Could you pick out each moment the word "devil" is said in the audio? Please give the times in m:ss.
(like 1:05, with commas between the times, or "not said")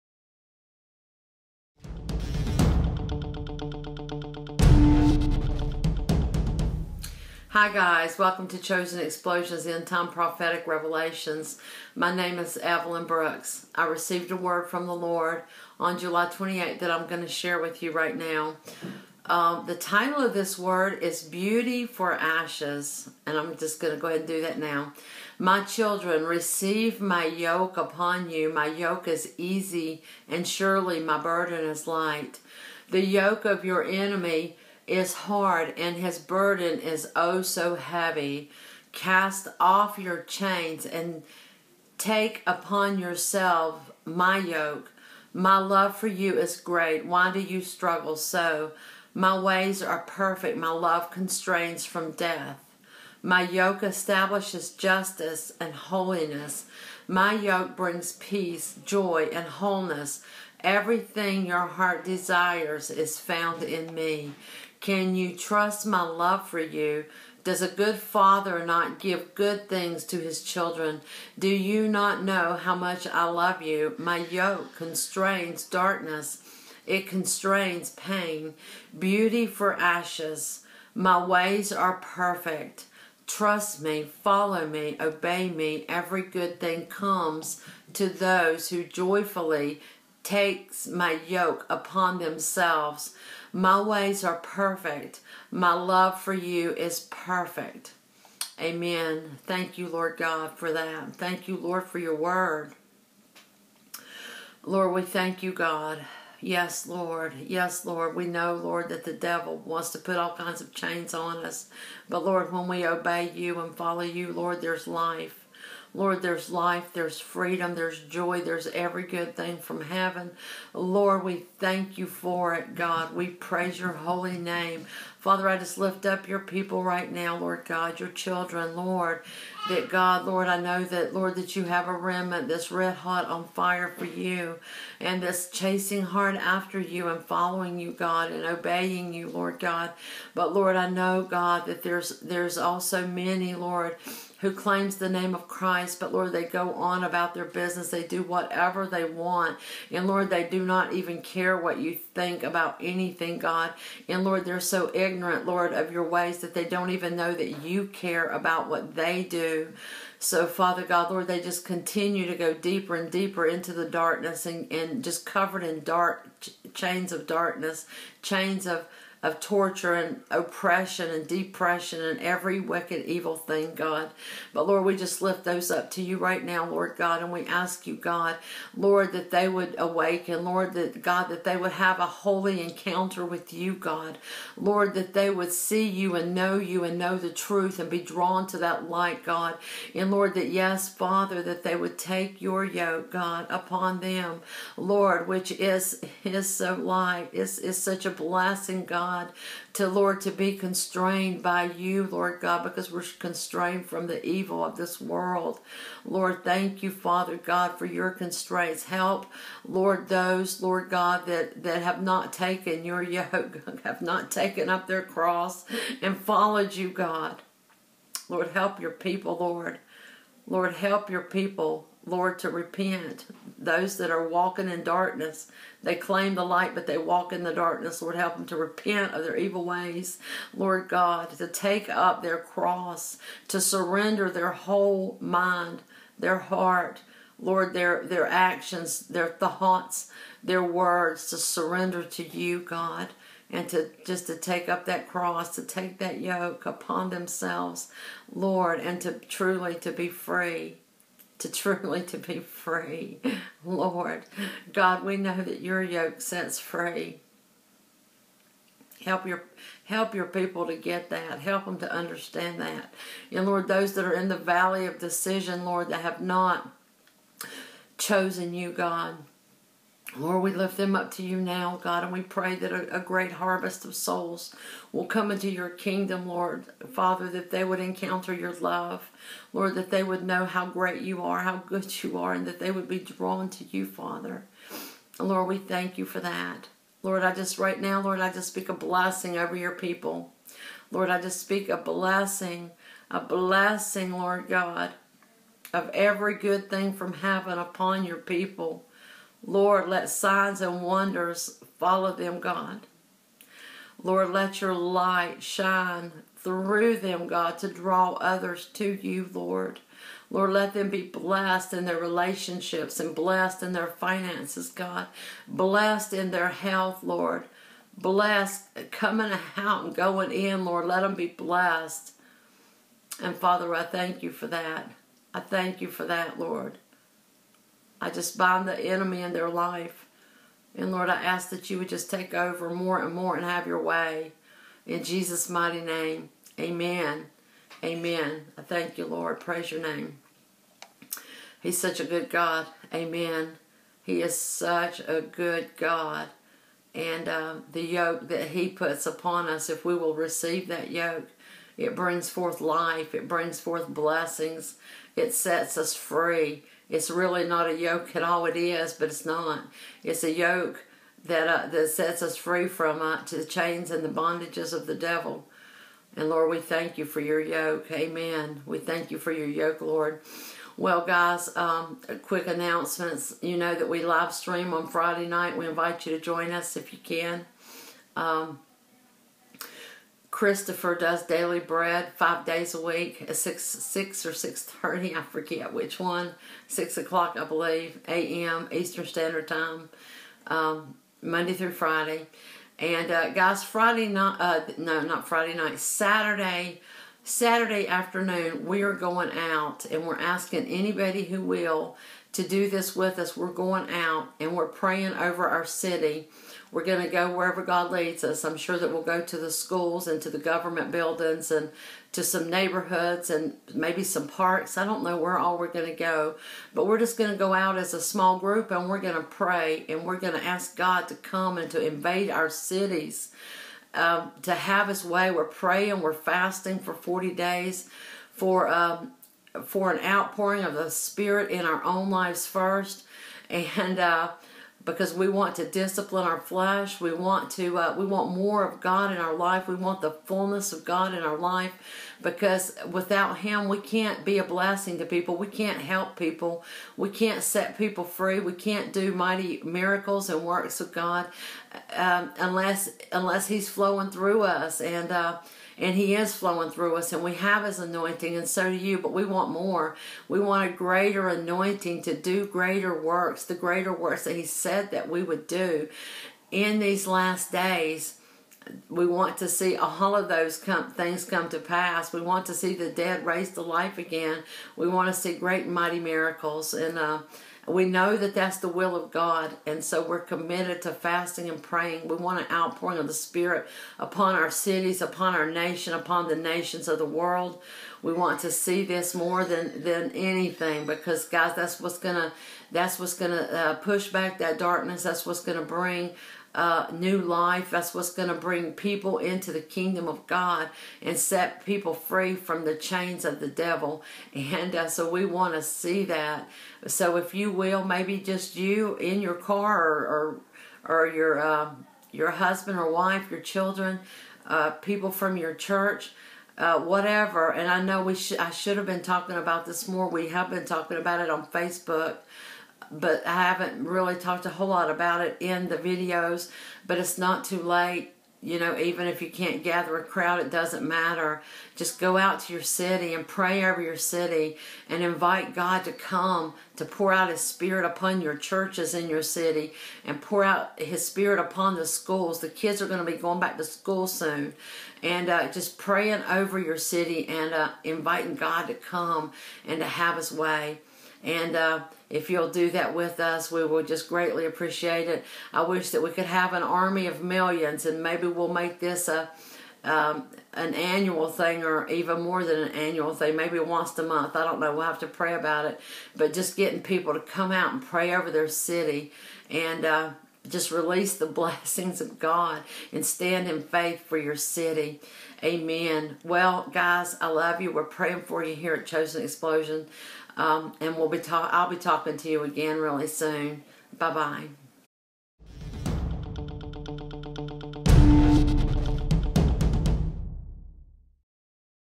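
1:49, 6:04, 8:23.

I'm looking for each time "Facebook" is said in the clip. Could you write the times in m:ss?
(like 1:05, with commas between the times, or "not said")
8:41.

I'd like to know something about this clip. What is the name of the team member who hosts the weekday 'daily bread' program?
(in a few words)
Christopher.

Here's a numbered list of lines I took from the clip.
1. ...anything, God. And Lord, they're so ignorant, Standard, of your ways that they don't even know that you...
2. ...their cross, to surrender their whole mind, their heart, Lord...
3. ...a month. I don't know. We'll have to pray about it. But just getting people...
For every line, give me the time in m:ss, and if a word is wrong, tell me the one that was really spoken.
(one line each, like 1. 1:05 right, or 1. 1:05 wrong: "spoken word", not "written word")
1. 2:32 wrong: "Lord", not "Standard"
2. 3:52 right
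3. 9:23 right.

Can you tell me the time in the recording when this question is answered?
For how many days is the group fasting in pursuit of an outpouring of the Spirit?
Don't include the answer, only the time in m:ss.
7:06.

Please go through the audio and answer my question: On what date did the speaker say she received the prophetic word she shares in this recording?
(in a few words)
July 28th.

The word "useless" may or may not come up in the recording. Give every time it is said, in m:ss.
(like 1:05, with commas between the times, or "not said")
not said.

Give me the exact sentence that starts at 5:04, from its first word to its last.
Lord, let your light shine through them, God, to draw others to you, Lord.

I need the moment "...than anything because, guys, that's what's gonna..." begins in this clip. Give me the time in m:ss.
8:09.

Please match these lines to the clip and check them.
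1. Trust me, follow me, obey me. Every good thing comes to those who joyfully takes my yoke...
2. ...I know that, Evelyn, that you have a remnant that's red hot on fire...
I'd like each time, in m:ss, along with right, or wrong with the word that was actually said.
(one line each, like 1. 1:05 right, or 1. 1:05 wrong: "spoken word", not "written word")
1. 1:23 right
2. 2:10 wrong: "Lord", not "Evelyn".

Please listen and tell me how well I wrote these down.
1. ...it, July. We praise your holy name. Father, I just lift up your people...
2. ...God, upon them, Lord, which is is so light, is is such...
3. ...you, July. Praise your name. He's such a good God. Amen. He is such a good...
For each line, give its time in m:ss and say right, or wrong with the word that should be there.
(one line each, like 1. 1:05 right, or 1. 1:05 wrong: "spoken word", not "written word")
1. 2:02 wrong: "God", not "July"
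2. 3:13 right
3. 5:38 wrong: "Lord", not "July".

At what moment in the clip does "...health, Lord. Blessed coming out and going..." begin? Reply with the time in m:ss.
5:16.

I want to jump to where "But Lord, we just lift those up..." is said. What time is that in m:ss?
2:54.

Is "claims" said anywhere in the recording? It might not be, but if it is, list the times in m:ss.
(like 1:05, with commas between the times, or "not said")
2:24, 3:45.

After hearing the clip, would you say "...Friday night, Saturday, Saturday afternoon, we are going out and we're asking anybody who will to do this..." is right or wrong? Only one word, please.
right.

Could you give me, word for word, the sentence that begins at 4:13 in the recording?
Lord, God, we know that your yoke sets free.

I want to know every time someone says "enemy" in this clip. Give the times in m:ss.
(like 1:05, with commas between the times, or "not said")
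0:33, 5:28.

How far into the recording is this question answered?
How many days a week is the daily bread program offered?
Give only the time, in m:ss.
6:22.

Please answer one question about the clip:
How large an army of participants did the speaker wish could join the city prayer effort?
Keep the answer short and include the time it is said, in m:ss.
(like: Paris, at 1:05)
millions, at 9:16.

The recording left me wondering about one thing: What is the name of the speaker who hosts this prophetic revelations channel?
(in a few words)
Evelyn Brooks.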